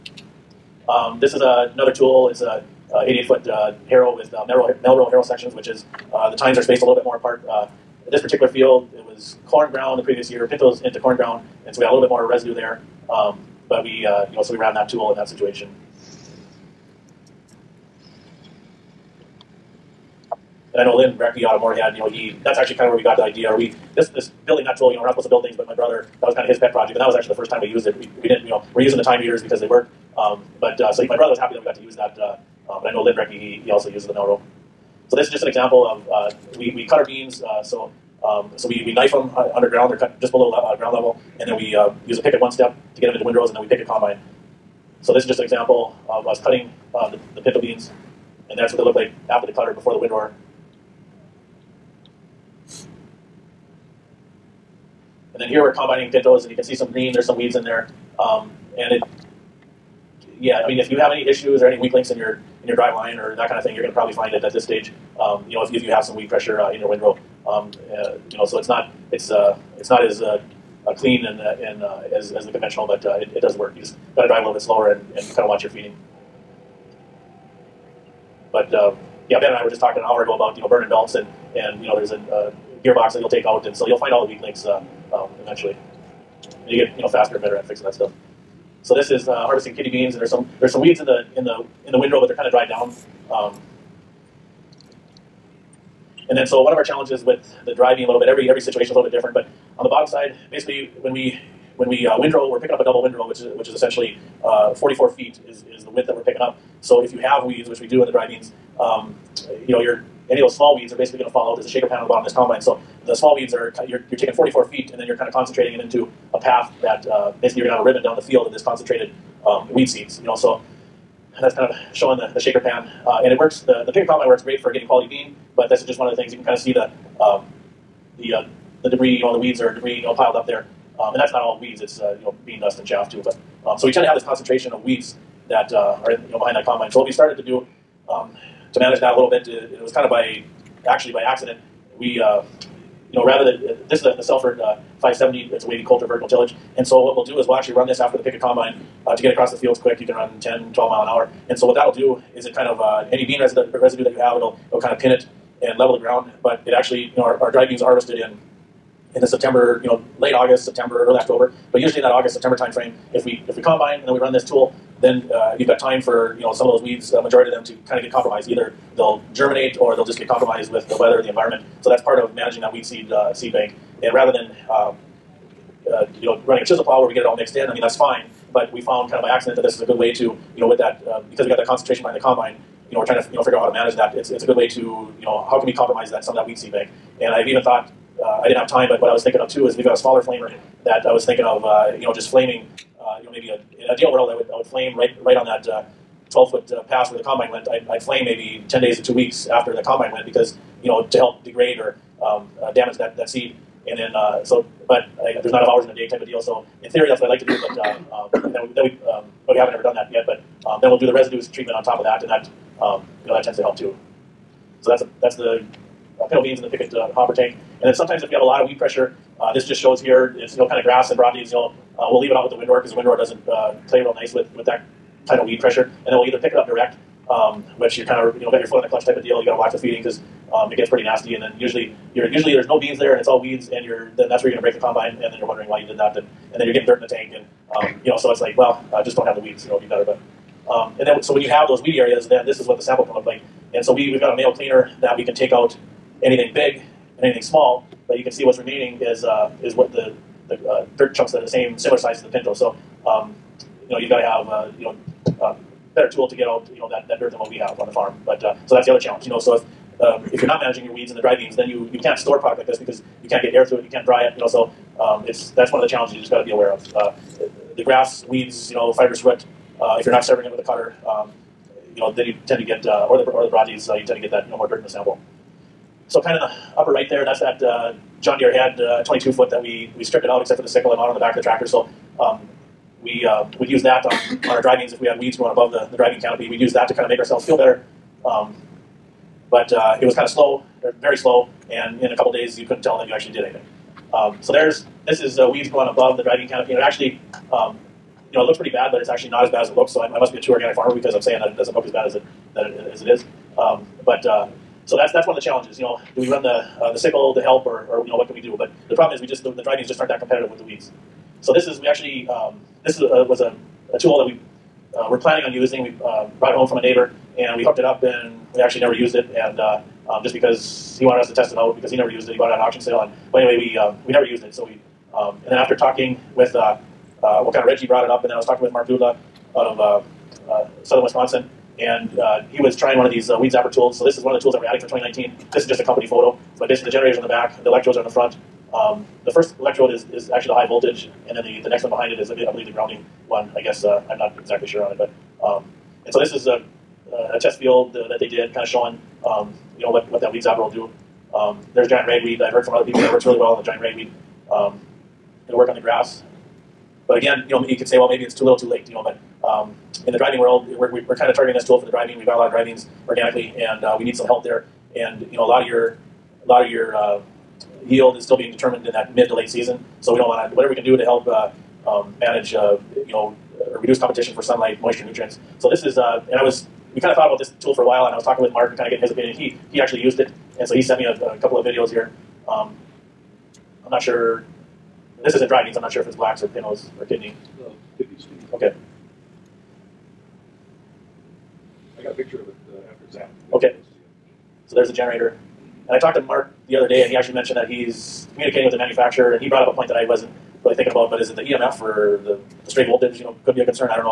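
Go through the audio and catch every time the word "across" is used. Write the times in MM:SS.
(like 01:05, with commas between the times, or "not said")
02:29.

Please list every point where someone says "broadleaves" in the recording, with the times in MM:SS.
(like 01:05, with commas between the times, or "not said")
03:41, 04:33.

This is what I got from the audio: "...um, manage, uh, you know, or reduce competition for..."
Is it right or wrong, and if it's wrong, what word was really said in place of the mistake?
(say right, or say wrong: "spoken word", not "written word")
right.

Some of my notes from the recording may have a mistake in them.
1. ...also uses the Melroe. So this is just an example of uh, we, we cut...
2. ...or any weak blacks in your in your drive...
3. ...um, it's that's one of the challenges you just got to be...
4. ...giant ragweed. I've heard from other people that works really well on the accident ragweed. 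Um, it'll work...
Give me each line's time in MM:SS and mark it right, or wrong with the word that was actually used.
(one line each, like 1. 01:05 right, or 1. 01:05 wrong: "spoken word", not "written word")
1. 00:33 right
2. 01:01 wrong: "links", not "blacks"
3. 04:24 right
4. 05:51 wrong: "giant", not "accident".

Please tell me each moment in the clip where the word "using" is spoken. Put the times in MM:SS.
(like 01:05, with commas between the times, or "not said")
00:28, 05:15.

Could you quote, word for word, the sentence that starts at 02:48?
Either they'll germinate or they'll just get compromised with the weather and the environment.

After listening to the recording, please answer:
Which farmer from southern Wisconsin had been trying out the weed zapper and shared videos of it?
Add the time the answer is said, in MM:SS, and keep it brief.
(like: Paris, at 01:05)
Mark Dudla, at 05:28.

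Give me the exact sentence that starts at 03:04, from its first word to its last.
It's, it's a good way to, you know, how can we compromise that, some of that weed seed bank?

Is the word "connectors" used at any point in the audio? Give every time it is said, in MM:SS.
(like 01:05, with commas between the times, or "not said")
not said.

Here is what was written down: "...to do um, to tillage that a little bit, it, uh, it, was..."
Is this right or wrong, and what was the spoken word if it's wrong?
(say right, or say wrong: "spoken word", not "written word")
wrong: "manage", not "tillage".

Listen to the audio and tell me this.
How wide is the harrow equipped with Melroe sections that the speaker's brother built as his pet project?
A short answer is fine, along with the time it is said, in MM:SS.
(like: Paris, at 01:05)
88-foot, at 00:02.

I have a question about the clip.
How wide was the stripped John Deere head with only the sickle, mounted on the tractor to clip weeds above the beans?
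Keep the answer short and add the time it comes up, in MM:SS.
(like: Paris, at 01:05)
22 foot, at 04:39.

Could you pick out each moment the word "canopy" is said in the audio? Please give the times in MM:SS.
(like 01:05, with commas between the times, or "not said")
04:46, 04:56.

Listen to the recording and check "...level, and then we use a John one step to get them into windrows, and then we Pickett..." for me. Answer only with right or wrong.
wrong.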